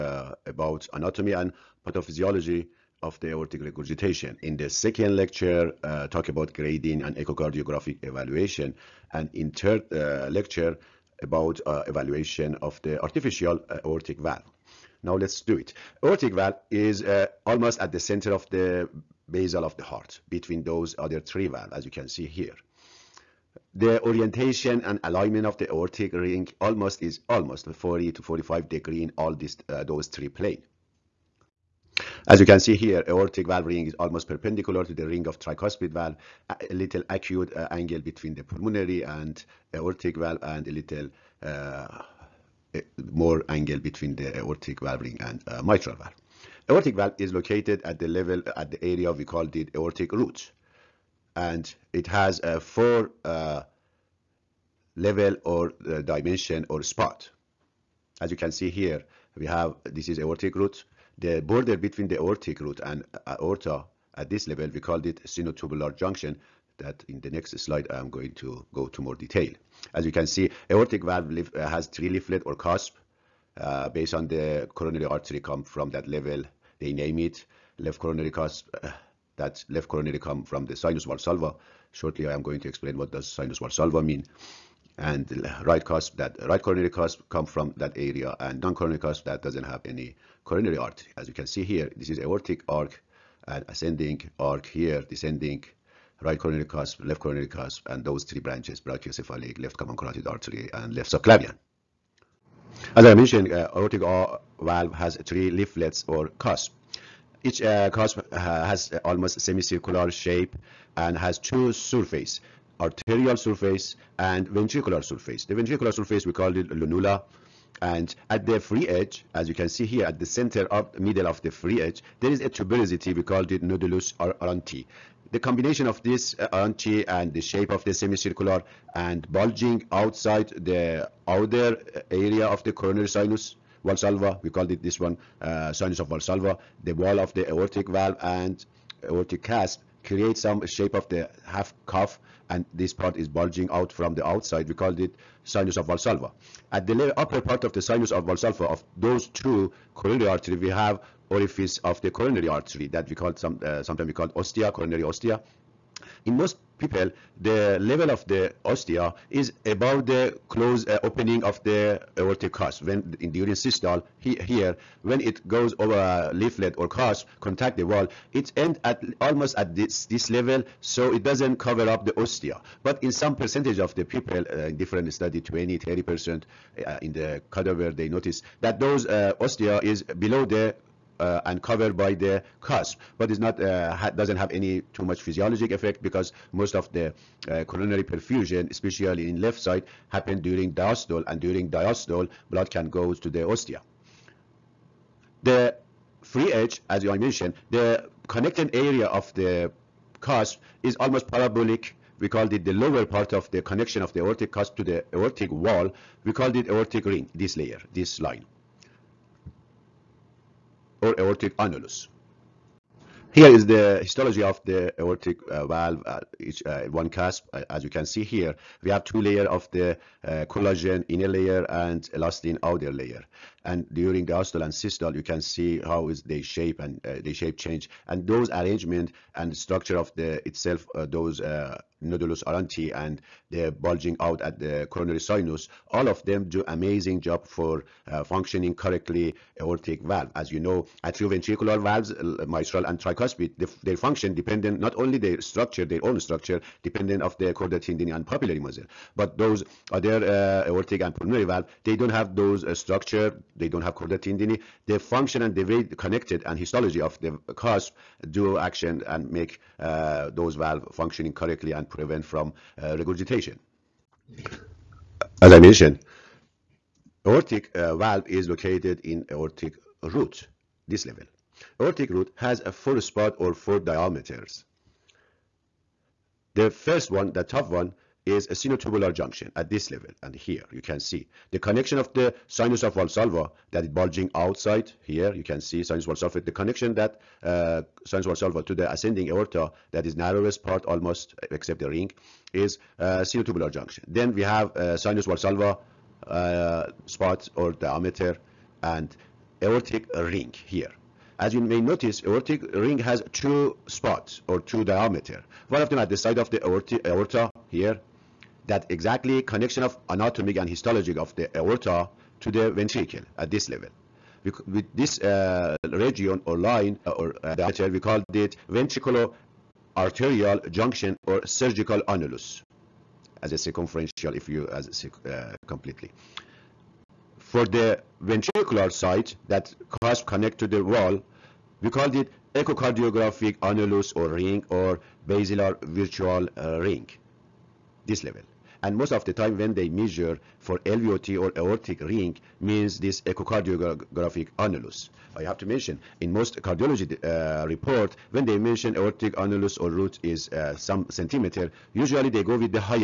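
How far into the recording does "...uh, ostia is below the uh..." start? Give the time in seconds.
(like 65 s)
179 s.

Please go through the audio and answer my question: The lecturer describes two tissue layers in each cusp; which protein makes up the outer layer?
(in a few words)
elastin.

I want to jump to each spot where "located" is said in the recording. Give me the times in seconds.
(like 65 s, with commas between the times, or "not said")
47 s, 268 s.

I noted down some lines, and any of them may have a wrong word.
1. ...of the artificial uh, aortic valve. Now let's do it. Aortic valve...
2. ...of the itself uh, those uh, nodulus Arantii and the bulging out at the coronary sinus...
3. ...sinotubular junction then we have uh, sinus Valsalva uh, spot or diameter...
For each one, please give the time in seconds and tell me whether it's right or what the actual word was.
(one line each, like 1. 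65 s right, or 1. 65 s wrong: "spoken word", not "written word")
1. 12 s right
2. 229 s right
3. 293 s right.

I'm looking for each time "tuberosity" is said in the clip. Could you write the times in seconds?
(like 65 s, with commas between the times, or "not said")
122 s.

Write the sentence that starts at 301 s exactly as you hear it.
As you may notice, aortic ring has two spots or two diameter.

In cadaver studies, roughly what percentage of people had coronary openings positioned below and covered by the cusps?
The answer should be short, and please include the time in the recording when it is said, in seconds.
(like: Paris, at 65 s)
20 to 30 percent, at 175 s.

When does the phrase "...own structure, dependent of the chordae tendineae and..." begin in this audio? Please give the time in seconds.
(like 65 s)
246 s.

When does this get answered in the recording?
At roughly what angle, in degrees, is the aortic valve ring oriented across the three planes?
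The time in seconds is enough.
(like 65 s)
27 s.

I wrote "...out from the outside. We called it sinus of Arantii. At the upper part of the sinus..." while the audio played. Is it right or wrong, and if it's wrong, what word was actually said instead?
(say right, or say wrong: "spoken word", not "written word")
wrong: "Valsalva", not "Arantii".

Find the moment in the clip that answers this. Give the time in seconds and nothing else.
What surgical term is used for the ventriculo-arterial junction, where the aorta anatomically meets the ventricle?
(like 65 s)
321 s.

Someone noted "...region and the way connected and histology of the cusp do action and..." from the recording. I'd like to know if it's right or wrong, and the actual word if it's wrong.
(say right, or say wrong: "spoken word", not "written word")
wrong: "function", not "region".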